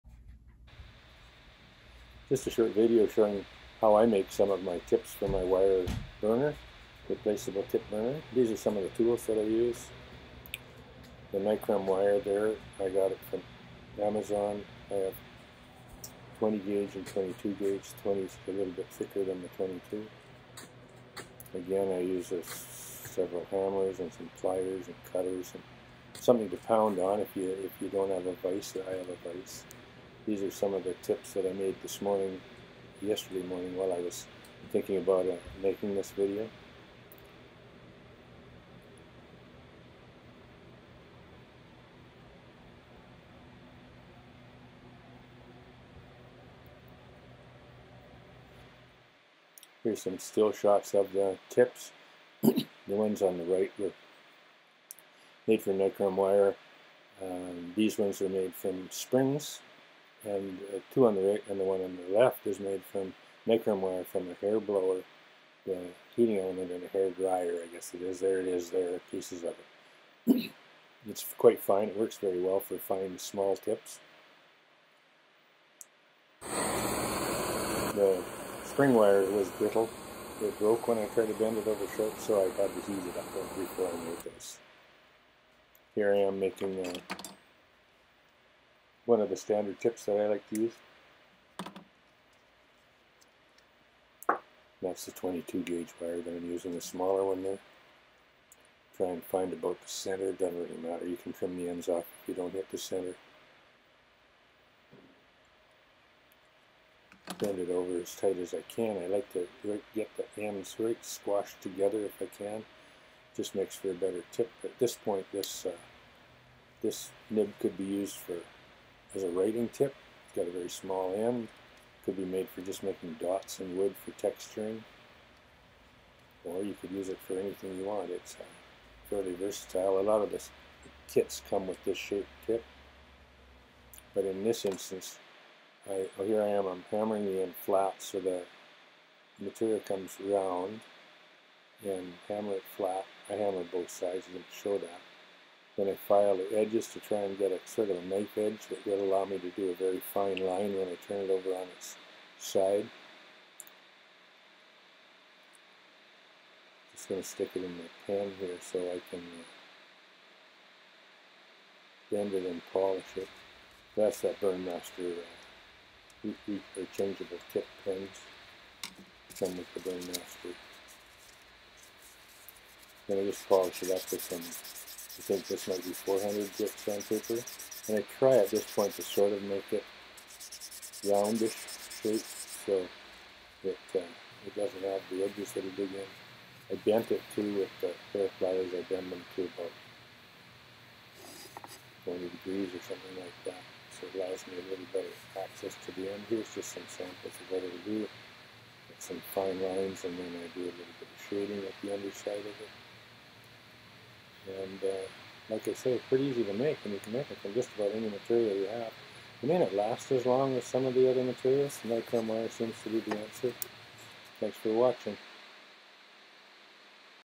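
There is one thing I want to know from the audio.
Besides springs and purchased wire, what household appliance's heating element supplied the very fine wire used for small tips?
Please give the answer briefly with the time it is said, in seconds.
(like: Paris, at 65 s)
Hair dryer, at 66 s.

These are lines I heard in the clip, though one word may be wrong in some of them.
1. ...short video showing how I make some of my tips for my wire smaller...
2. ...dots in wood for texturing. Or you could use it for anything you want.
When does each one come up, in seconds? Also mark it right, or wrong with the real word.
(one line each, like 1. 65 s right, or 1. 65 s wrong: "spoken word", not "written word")
1. 2 s wrong: "burner", not "smaller"
2. 123 s right.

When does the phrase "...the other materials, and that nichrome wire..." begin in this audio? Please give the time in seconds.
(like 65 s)
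210 s.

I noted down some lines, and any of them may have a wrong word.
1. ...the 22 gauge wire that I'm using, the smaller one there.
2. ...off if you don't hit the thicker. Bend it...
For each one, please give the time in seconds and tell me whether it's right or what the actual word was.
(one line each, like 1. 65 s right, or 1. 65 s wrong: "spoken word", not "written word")
1. 95 s right
2. 101 s wrong: "center", not "thicker".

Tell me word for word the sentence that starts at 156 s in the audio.
Just going to stick it in the pan here so I can uh, bend it and polish it.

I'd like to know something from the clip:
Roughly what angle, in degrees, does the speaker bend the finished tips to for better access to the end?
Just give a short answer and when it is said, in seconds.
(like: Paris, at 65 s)
40 degrees, at 192 s.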